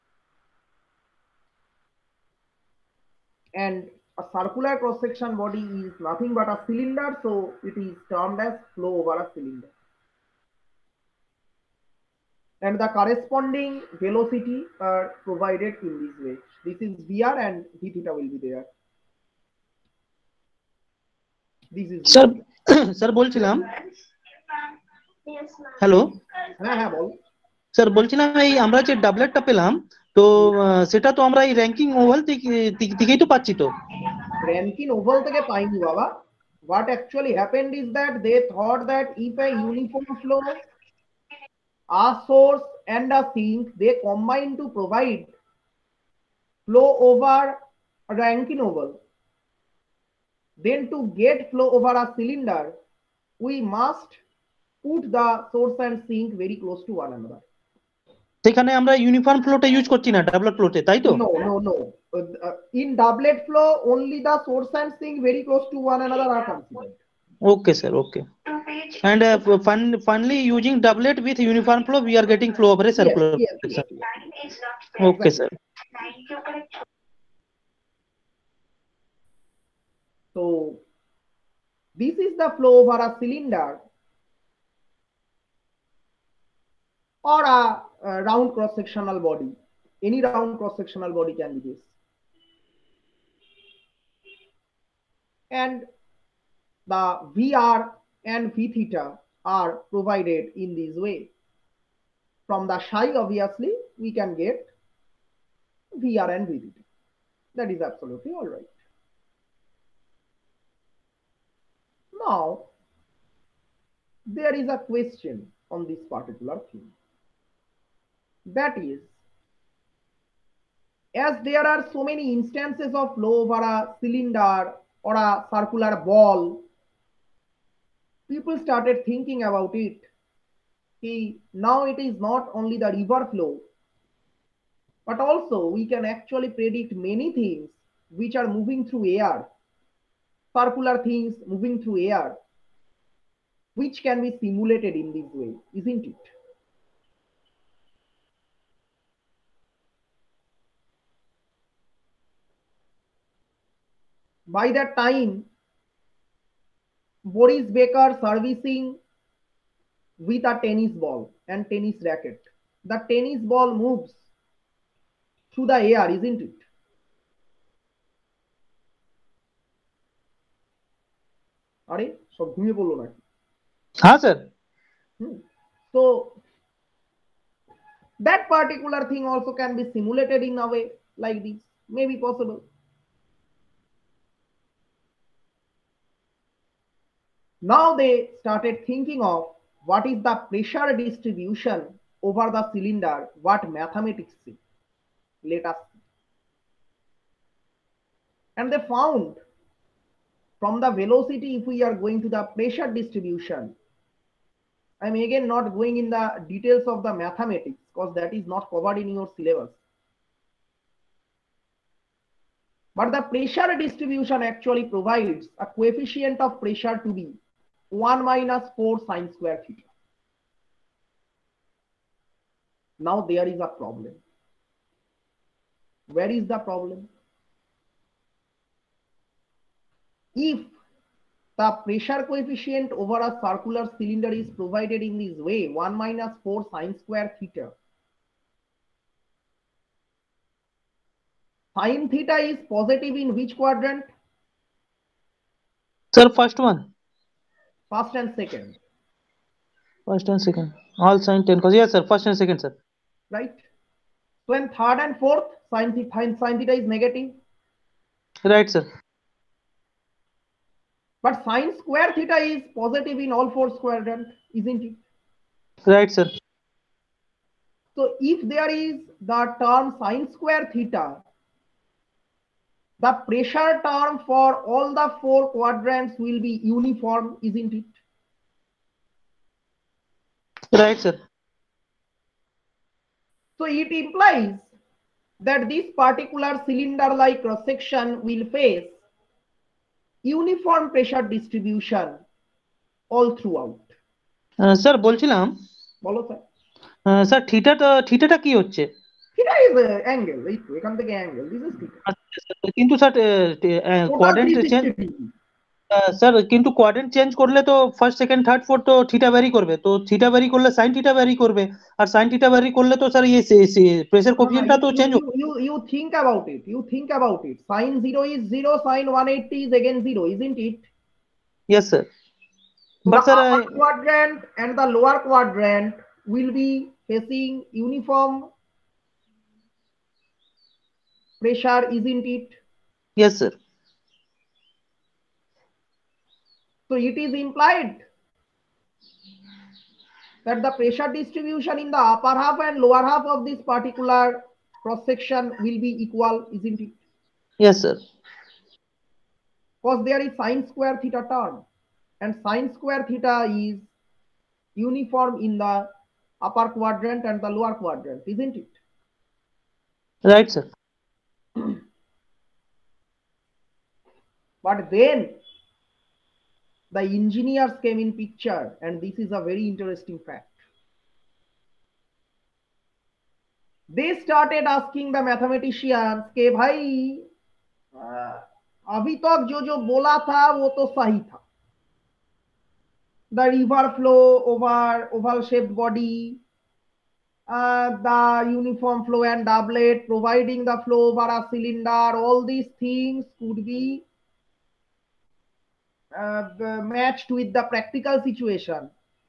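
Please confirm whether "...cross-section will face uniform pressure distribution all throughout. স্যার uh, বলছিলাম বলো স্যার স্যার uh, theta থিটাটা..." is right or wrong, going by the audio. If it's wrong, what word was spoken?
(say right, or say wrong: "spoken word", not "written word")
right.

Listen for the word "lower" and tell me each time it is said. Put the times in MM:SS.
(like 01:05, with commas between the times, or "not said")
05:24, 05:42, 05:57.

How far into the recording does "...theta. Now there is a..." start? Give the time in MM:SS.
03:39.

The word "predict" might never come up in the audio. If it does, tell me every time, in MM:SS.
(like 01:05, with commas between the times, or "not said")
02:16.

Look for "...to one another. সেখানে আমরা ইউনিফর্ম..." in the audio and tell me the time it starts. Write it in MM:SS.
00:56.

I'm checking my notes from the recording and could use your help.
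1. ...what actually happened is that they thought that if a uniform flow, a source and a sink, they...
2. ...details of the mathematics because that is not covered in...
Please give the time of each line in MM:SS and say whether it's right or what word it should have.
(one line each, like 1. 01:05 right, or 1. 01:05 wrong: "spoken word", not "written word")
1. 00:36 right
2. 03:26 right.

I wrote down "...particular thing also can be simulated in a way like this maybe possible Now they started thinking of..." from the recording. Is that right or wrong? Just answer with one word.
right.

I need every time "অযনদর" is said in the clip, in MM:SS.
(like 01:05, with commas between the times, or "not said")
01:06.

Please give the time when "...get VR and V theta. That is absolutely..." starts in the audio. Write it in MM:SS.
01:44.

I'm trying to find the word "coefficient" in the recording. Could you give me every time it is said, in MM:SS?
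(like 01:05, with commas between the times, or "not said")
03:35, 03:52.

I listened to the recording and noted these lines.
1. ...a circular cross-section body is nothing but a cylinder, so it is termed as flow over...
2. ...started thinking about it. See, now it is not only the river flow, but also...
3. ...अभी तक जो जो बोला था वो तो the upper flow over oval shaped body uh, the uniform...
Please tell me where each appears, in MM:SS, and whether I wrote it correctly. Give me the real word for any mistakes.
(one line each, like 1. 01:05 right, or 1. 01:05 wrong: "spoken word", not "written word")
1. 00:04 right
2. 02:08 right
3. 06:18 wrong: "river", not "upper".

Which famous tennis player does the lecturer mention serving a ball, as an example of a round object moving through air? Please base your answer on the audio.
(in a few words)
Boris Becker.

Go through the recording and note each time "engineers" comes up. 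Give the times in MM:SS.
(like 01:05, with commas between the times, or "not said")
06:07.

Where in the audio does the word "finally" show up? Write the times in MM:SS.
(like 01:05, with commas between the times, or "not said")
01:10.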